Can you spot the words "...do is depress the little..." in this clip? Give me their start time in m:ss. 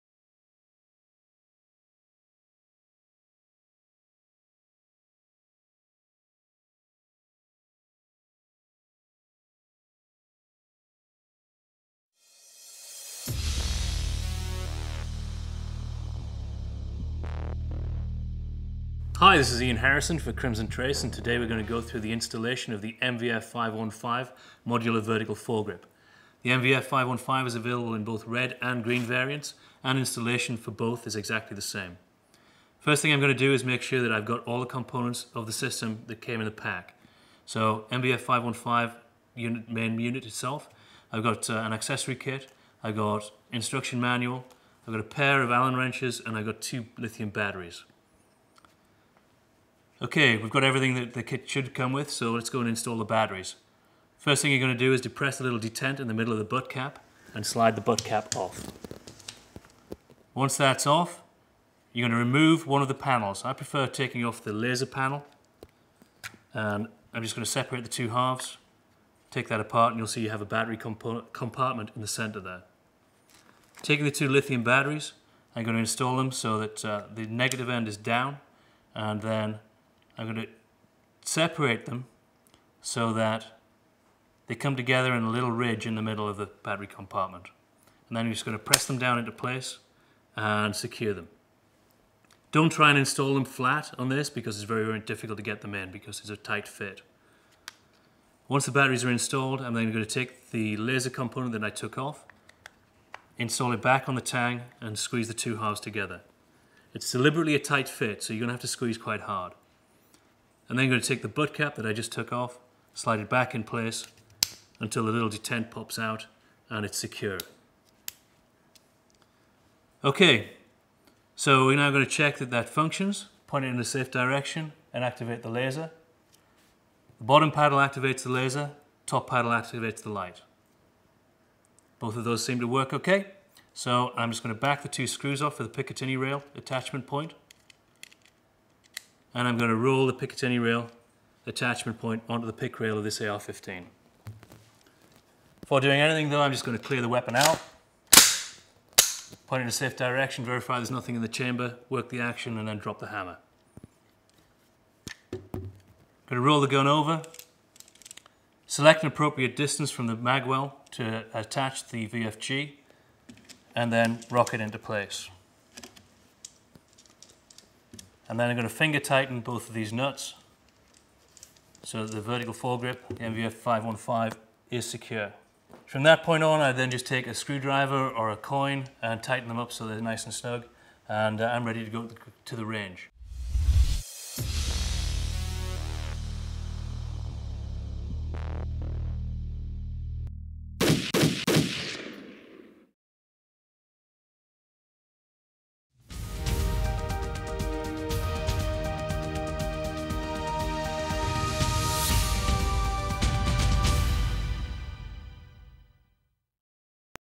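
0:54.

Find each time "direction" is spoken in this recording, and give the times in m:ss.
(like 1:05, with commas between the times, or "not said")
2:04, 2:29.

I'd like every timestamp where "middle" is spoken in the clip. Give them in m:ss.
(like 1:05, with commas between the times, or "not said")
0:56, 1:26.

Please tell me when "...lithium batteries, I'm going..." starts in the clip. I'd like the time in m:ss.
1:14.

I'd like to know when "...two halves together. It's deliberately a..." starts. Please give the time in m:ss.
1:45.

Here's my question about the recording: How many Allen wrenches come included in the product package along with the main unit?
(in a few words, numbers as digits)
2.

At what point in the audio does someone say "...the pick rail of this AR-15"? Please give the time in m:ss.
2:22.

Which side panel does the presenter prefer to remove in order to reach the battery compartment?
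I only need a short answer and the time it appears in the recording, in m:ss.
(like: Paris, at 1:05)
the laser panel, at 1:04.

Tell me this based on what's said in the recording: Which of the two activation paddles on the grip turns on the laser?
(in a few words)
the bottom paddle.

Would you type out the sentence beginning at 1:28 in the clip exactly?
And then i are just going to press them down into place and secure them.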